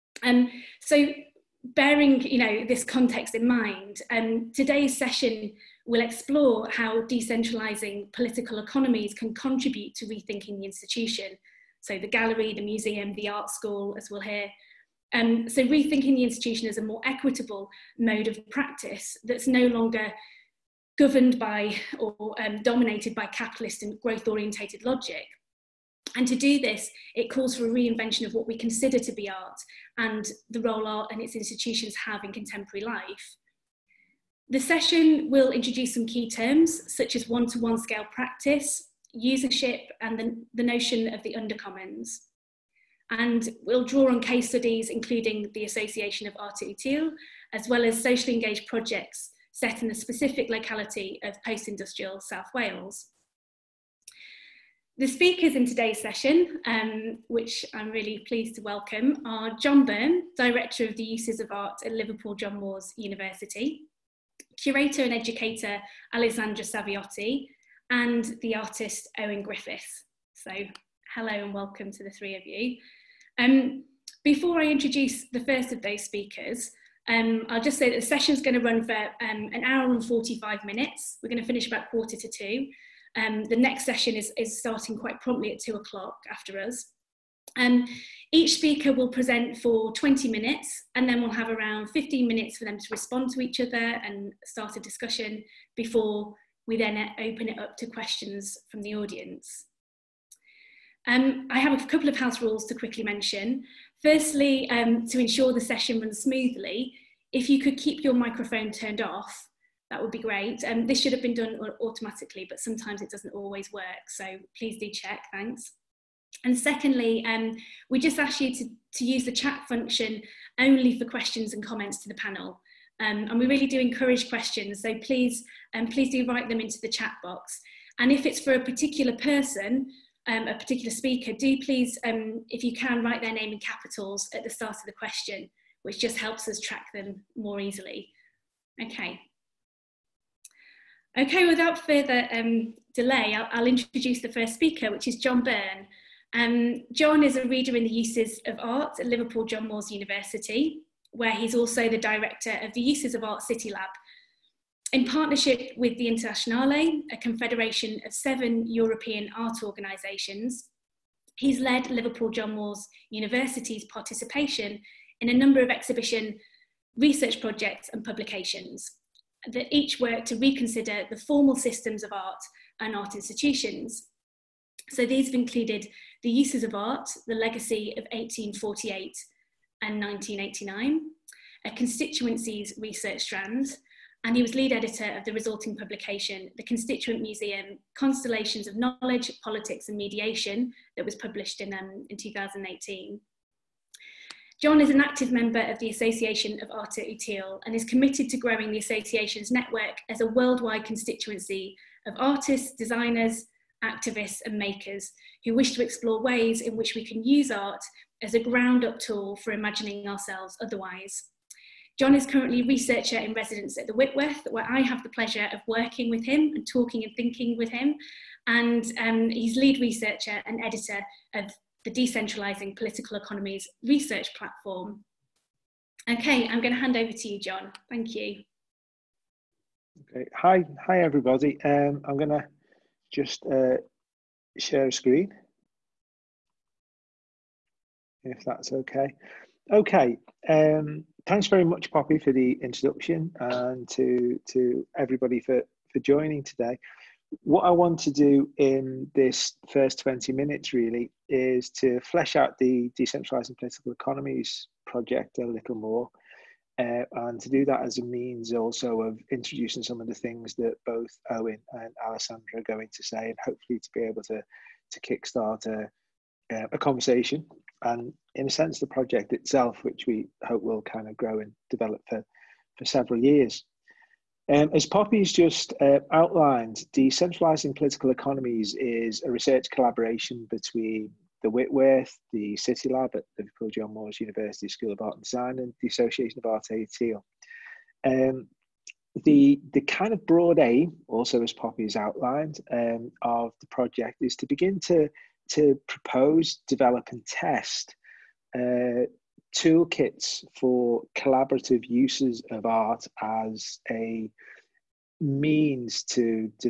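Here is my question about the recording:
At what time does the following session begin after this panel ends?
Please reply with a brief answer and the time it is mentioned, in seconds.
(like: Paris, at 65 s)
2 o'clock, at 85 s.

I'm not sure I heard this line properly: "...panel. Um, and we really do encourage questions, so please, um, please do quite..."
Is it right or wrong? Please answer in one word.
wrong.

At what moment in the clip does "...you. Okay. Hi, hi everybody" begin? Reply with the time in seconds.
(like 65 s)
228 s.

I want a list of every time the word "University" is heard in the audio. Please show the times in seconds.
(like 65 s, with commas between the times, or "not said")
62 s, 149 s, 163 s, 284 s.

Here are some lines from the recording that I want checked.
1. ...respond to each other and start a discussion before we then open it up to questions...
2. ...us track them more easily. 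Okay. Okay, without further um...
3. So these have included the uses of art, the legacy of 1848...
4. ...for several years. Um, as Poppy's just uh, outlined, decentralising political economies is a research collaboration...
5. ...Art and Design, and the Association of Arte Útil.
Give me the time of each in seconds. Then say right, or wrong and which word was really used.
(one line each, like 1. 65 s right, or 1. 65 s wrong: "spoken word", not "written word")
1. 92 s right
2. 136 s right
3. 174 s right
4. 272 s right
5. 285 s right.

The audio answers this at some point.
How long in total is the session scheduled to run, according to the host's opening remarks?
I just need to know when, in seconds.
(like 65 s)
79 s.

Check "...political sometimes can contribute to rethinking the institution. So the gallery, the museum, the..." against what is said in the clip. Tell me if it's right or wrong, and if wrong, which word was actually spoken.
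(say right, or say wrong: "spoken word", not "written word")
wrong: "economies", not "sometimes".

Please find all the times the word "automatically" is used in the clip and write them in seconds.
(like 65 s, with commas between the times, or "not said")
111 s.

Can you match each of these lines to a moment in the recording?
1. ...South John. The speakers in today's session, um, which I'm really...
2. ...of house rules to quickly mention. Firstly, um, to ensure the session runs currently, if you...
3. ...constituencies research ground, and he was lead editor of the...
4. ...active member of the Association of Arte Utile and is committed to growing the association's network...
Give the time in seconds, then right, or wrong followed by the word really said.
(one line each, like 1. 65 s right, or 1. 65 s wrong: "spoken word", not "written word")
1. 52 s wrong: "Wales", not "John"
2. 102 s wrong: "smoothly", not "currently"
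3. 181 s wrong: "strand", not "ground"
4. 195 s right.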